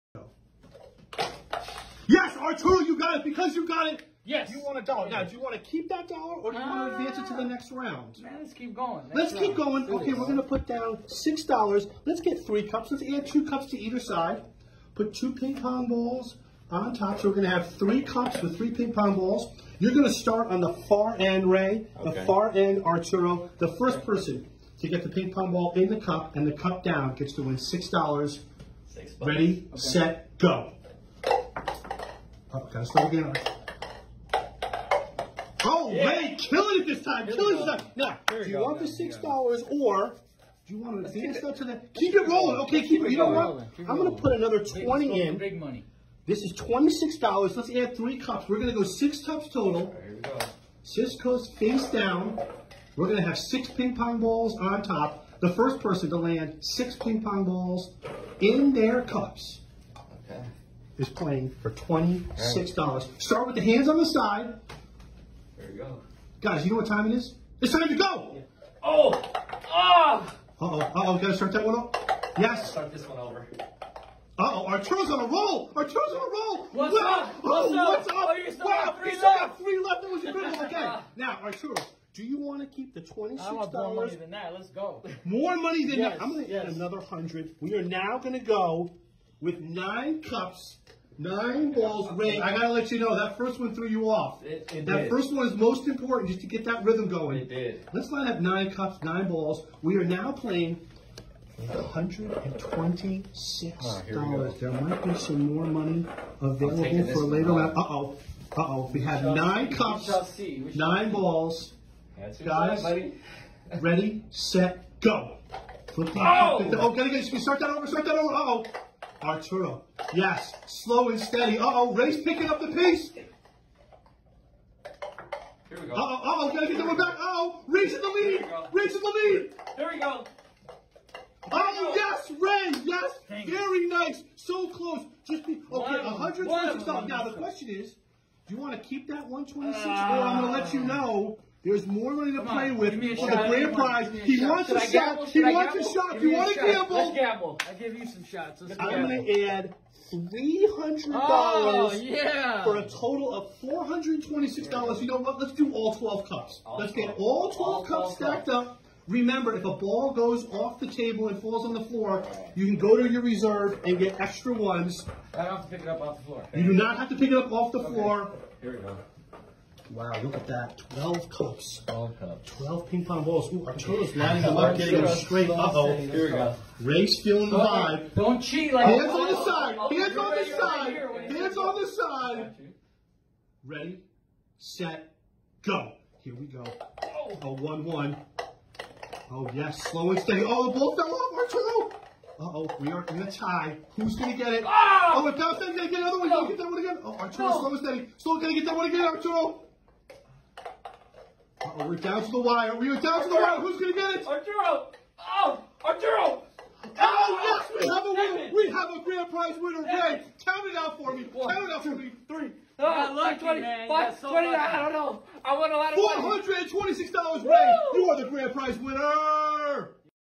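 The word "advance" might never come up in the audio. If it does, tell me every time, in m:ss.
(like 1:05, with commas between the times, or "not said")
0:06, 0:41.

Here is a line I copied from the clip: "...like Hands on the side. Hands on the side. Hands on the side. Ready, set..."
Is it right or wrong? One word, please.
right.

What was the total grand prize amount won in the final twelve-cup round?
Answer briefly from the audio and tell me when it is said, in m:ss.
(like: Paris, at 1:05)
$426, at 3:35.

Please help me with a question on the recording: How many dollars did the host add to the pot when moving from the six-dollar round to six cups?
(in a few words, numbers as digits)
20.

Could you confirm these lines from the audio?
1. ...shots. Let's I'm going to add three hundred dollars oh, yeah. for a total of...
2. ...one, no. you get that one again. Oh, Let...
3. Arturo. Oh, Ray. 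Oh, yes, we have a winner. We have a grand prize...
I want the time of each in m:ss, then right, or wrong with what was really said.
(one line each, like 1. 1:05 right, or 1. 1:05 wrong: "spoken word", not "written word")
1. 2:28 right
2. 3:16 wrong: "Arturo", not "Let"
3. 3:24 wrong: "Arturo", not "Ray".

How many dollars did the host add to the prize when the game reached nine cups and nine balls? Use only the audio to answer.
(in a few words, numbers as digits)
100.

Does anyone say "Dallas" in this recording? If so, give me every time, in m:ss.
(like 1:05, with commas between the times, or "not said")
3:15.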